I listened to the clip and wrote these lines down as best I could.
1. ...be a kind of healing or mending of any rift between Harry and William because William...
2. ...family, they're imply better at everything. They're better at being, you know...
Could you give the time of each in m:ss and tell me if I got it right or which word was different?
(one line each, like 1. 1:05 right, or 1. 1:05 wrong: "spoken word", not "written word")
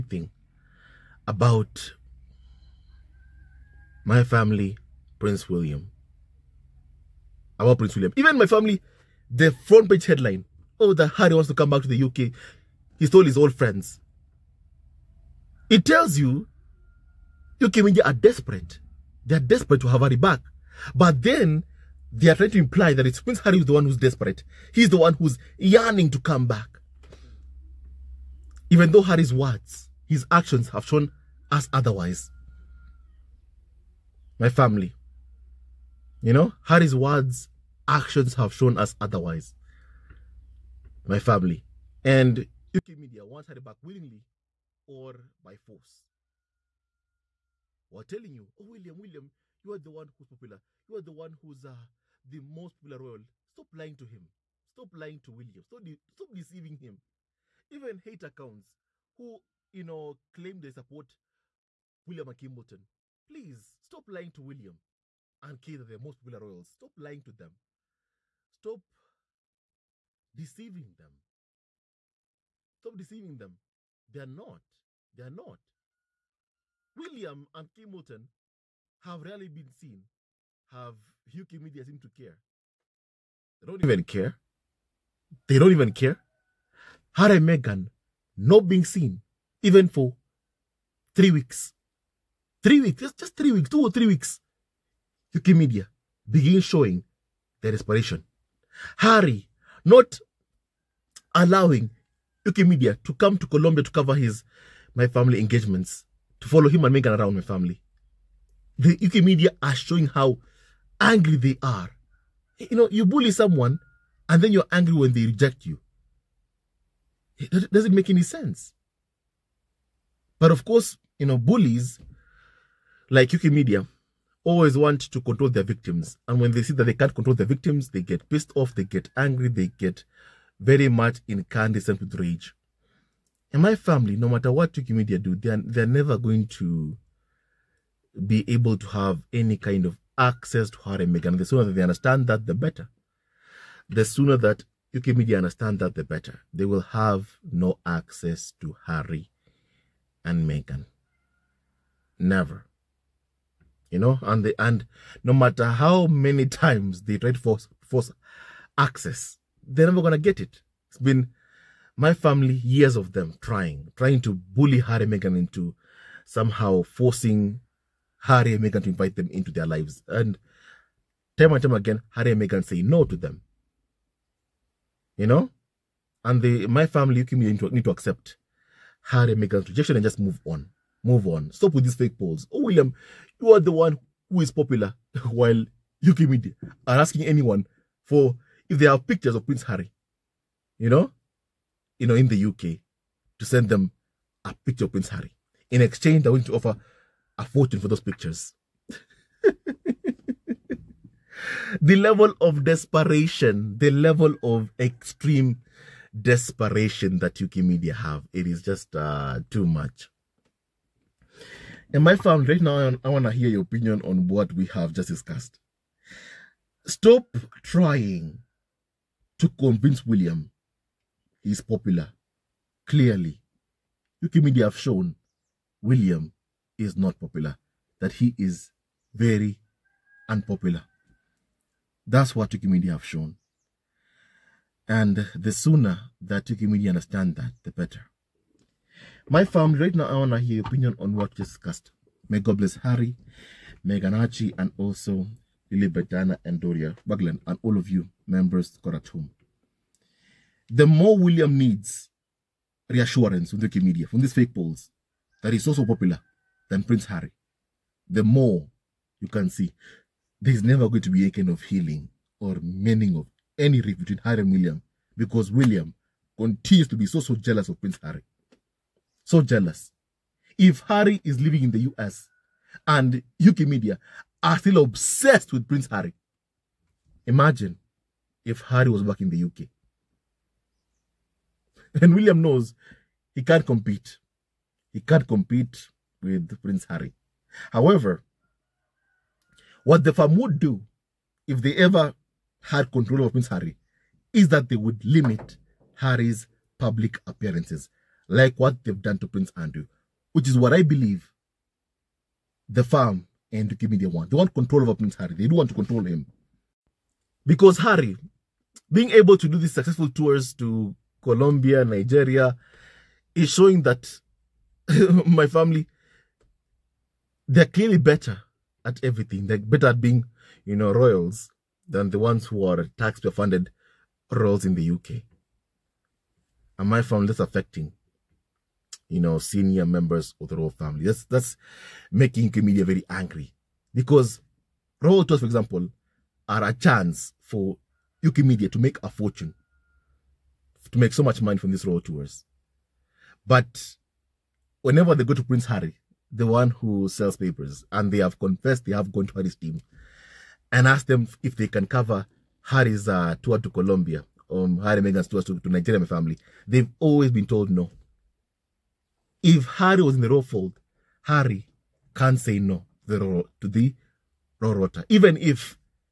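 1. 4:21 right
2. 5:15 wrong: "clearly", not "imply".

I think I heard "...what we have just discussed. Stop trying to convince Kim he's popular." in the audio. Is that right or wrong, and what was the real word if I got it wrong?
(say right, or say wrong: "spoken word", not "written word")
wrong: "William", not "Kim".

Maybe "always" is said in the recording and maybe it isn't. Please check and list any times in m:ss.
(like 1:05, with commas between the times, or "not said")
2:04, 5:56.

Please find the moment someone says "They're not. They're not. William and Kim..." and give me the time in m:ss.
1:14.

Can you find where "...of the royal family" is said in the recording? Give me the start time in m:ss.
5:30.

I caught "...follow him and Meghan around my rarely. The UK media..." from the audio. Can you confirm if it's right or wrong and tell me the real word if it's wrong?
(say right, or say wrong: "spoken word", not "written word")
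wrong: "family", not "rarely".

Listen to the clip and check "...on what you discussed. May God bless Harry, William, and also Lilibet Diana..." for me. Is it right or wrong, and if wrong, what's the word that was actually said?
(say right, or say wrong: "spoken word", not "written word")
wrong: "Archie", not "William".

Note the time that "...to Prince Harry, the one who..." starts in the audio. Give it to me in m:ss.
5:45.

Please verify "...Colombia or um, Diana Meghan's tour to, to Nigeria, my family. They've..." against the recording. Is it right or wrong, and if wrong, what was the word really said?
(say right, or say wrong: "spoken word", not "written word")
wrong: "Harry", not "Diana".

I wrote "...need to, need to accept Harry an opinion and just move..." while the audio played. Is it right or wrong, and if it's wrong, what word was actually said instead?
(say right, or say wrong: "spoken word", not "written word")
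wrong: "rejection", not "opinion".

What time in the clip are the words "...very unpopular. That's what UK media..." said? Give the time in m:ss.
3:49.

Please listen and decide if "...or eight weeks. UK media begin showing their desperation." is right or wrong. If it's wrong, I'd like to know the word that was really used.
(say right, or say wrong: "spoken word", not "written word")
wrong: "three", not "eight".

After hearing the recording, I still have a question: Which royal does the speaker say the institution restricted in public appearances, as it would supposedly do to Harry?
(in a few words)
Prince Andrew.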